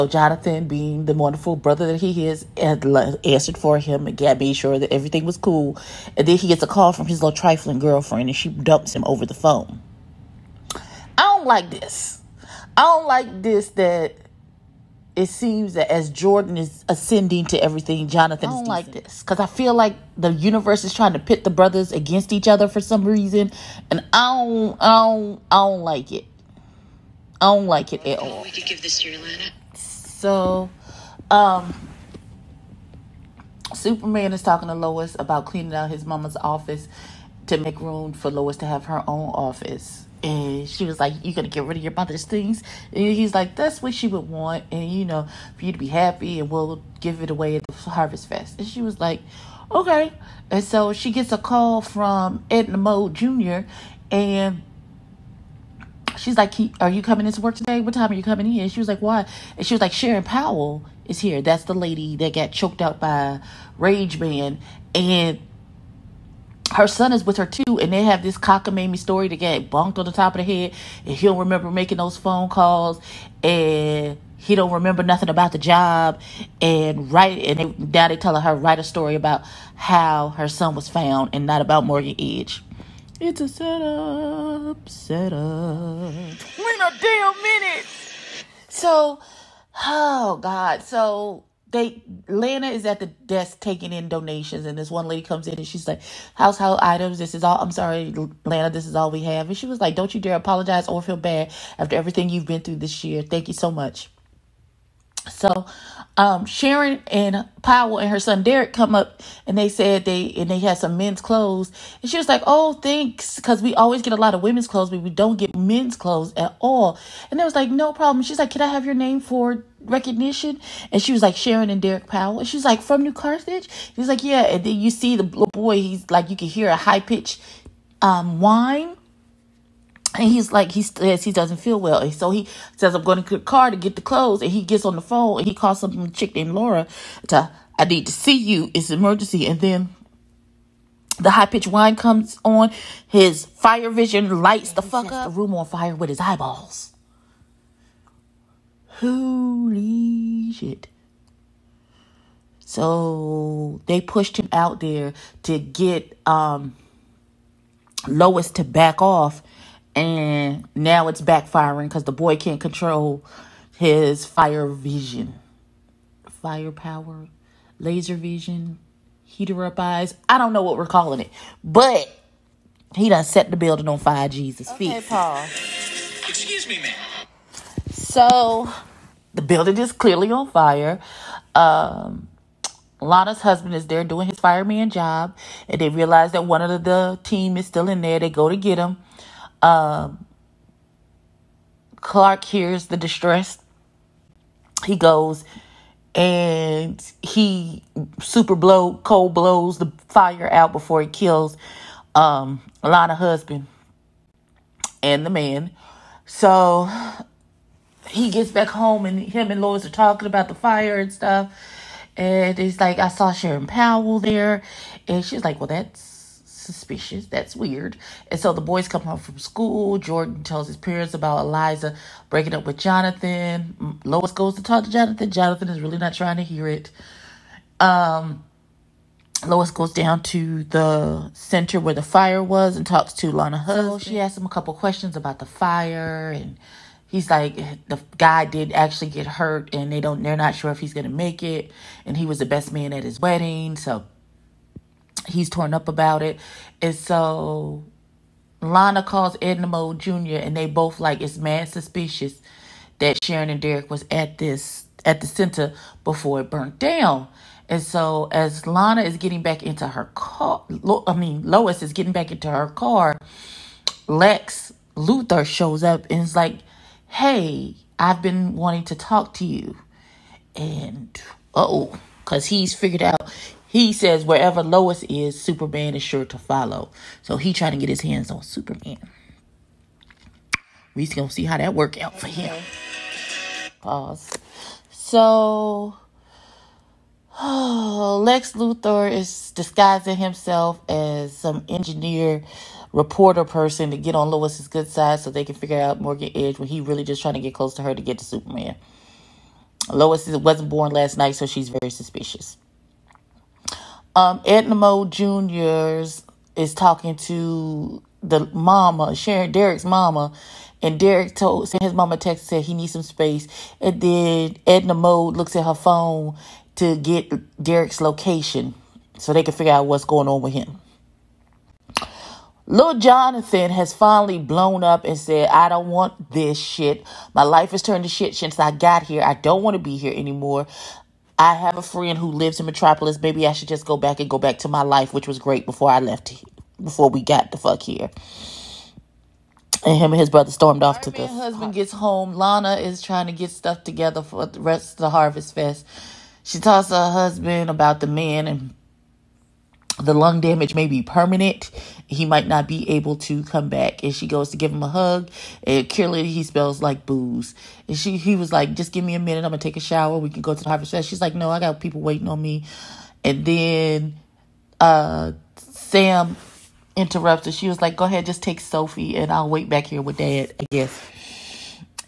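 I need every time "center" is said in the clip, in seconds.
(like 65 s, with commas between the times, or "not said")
231 s, 255 s.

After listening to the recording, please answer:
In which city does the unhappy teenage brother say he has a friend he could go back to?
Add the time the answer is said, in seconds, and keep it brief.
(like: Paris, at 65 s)
Metropolis, at 332 s.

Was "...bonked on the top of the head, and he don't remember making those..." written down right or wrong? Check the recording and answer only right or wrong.
right.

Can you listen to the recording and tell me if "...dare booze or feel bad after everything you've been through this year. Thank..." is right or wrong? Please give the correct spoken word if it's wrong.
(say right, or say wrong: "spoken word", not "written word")
wrong: "apologize", not "booze".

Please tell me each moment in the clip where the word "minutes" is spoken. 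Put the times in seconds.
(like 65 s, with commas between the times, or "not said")
87 s, 359 s.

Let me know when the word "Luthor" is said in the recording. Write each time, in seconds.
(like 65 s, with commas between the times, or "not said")
264 s, 288 s.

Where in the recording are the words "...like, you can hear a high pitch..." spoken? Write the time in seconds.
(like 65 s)
126 s.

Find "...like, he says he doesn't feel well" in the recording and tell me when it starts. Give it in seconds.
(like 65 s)
130 s.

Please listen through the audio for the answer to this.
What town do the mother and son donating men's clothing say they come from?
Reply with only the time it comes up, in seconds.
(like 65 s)
123 s.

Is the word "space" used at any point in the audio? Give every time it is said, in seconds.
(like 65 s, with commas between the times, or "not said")
313 s.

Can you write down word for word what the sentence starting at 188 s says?
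They go to get him um, Clark hears the distress.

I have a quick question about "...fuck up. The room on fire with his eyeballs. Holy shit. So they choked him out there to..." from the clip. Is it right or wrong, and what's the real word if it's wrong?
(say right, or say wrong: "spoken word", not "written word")
wrong: "pushed", not "choked".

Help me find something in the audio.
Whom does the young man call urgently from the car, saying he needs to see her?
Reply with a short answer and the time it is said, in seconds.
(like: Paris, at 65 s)
Laura, at 136 s.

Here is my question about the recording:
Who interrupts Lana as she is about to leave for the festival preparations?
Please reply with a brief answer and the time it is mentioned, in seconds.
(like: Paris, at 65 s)
Sam, at 365 s.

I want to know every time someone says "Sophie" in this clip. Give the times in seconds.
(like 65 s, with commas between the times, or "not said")
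368 s.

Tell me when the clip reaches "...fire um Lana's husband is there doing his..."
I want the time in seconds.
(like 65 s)
180 s.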